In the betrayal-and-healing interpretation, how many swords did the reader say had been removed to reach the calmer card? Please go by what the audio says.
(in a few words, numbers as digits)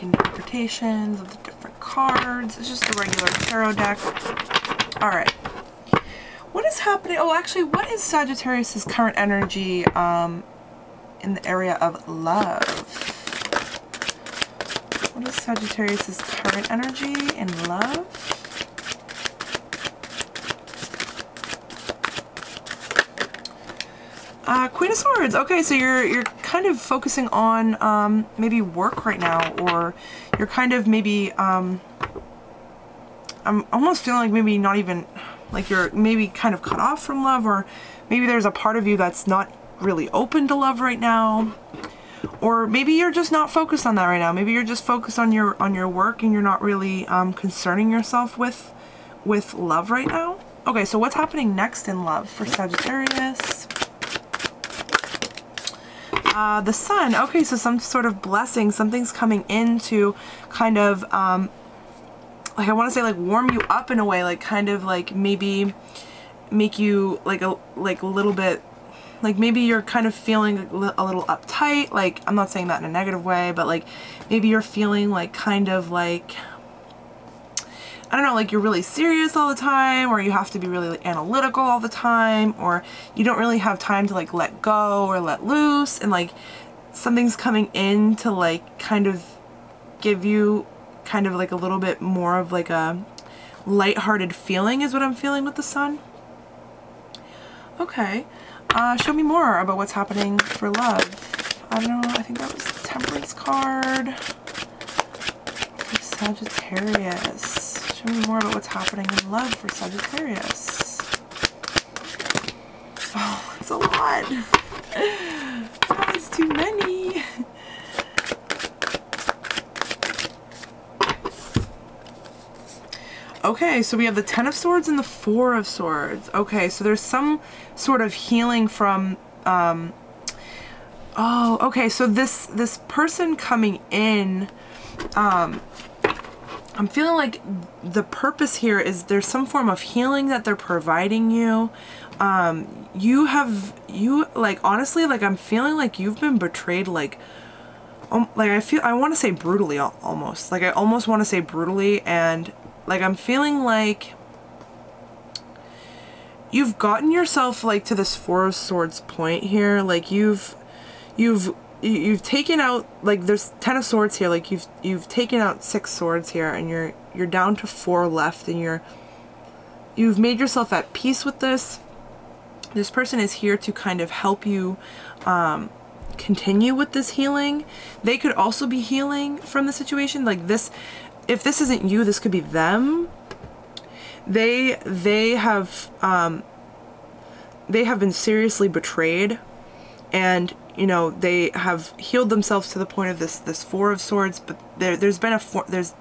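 6.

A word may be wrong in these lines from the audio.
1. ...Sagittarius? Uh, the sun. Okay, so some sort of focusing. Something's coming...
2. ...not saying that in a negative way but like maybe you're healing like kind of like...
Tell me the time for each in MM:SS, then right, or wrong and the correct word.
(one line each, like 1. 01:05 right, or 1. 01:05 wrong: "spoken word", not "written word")
1. 00:52 wrong: "blessing", not "focusing"
2. 01:12 wrong: "feeling", not "healing".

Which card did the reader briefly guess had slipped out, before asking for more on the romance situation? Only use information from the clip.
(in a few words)
Temperance.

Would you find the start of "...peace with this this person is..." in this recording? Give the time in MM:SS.
02:50.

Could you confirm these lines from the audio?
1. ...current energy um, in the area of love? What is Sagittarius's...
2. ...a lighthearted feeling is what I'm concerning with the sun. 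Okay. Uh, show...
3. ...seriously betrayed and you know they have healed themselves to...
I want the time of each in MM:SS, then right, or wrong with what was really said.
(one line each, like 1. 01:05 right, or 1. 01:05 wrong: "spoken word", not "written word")
1. 00:08 right
2. 01:32 wrong: "feeling", not "concerning"
3. 03:08 right.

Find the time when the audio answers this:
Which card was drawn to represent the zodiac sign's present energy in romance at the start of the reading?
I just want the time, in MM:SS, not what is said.
00:24.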